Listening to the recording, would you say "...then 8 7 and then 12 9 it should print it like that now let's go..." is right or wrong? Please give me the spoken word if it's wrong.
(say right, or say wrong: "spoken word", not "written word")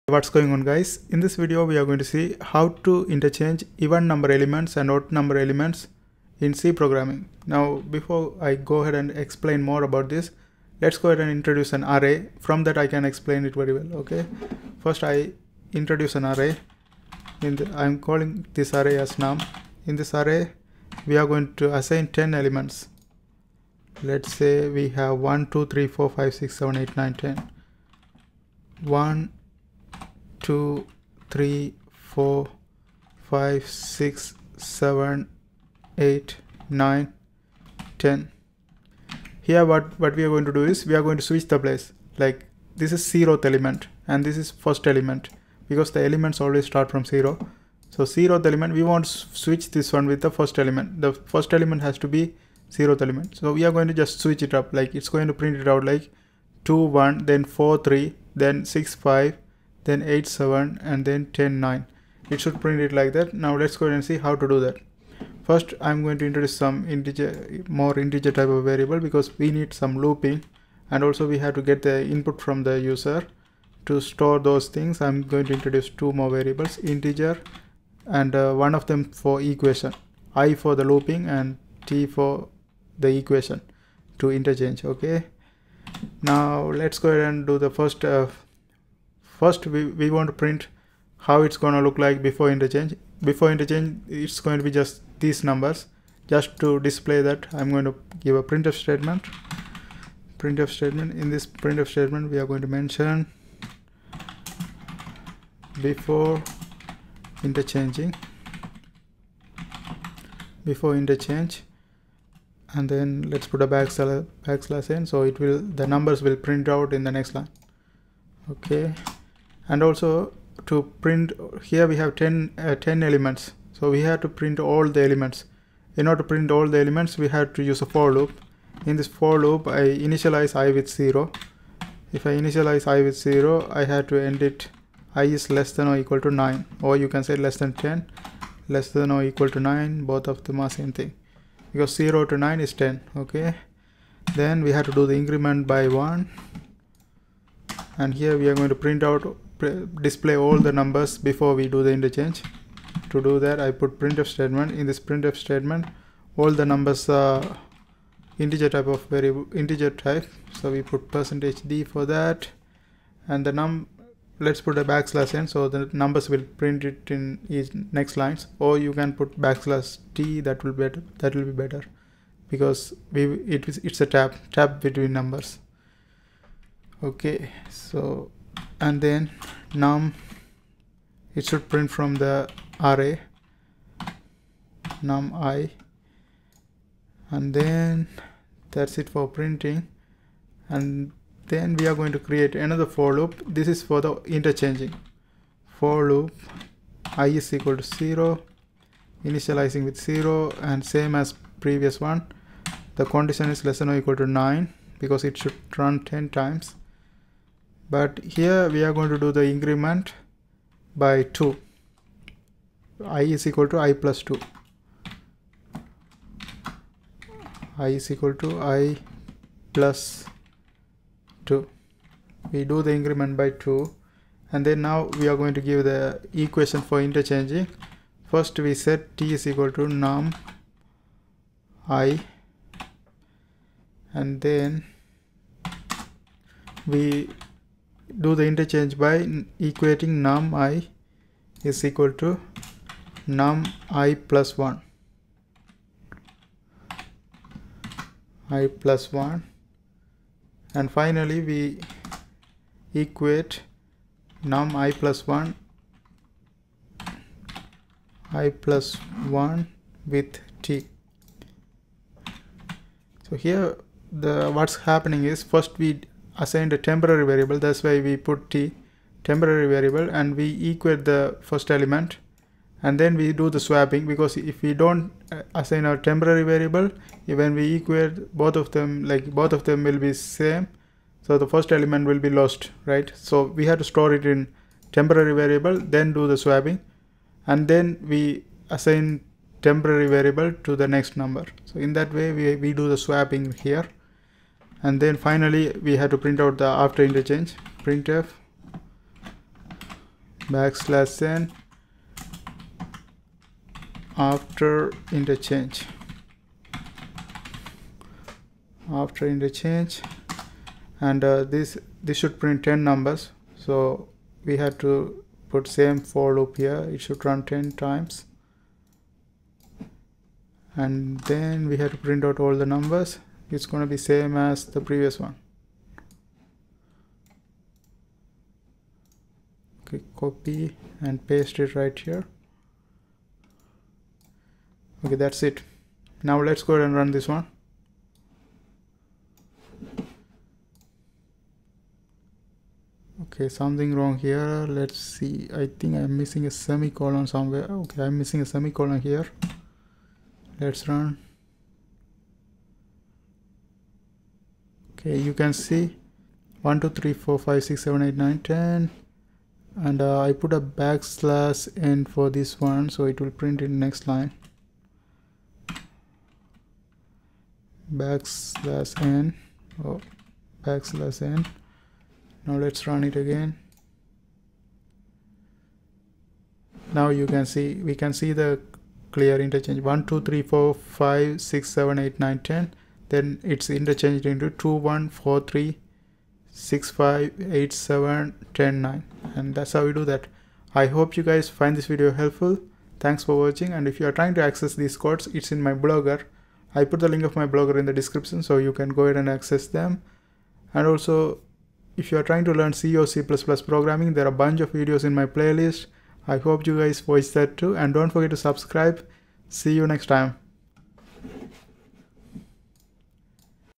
wrong: "10", not "12".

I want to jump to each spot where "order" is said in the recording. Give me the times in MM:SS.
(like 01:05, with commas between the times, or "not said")
02:06.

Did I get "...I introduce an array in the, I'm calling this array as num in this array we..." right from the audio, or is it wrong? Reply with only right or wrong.
right.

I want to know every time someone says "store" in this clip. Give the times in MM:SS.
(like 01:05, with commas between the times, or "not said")
01:13, 04:43.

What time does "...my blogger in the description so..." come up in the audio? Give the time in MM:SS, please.
06:37.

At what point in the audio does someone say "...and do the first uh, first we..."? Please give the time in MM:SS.
01:27.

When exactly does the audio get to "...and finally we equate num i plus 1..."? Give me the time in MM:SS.
04:10.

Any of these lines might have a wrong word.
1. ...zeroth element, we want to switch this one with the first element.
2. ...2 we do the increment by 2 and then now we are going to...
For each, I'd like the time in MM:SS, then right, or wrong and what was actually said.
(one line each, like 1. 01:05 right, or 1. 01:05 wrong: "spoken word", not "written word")
1. 00:48 right
2. 03:41 right.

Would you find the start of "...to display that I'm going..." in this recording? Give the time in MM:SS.
01:36.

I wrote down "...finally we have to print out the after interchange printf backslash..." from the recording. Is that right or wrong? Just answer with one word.
right.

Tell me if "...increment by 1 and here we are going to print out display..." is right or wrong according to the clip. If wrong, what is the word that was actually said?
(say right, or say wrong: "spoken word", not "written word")
right.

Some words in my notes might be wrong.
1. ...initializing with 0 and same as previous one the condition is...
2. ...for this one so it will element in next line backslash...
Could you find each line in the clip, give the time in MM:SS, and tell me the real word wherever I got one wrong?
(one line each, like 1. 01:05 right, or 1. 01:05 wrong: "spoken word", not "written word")
1. 03:19 right
2. 06:02 wrong: "print", not "element".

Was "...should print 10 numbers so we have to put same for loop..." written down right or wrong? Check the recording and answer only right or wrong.
right.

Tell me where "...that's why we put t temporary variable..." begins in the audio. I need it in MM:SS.
04:27.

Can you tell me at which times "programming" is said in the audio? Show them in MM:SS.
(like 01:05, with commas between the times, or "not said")
00:06, 06:43.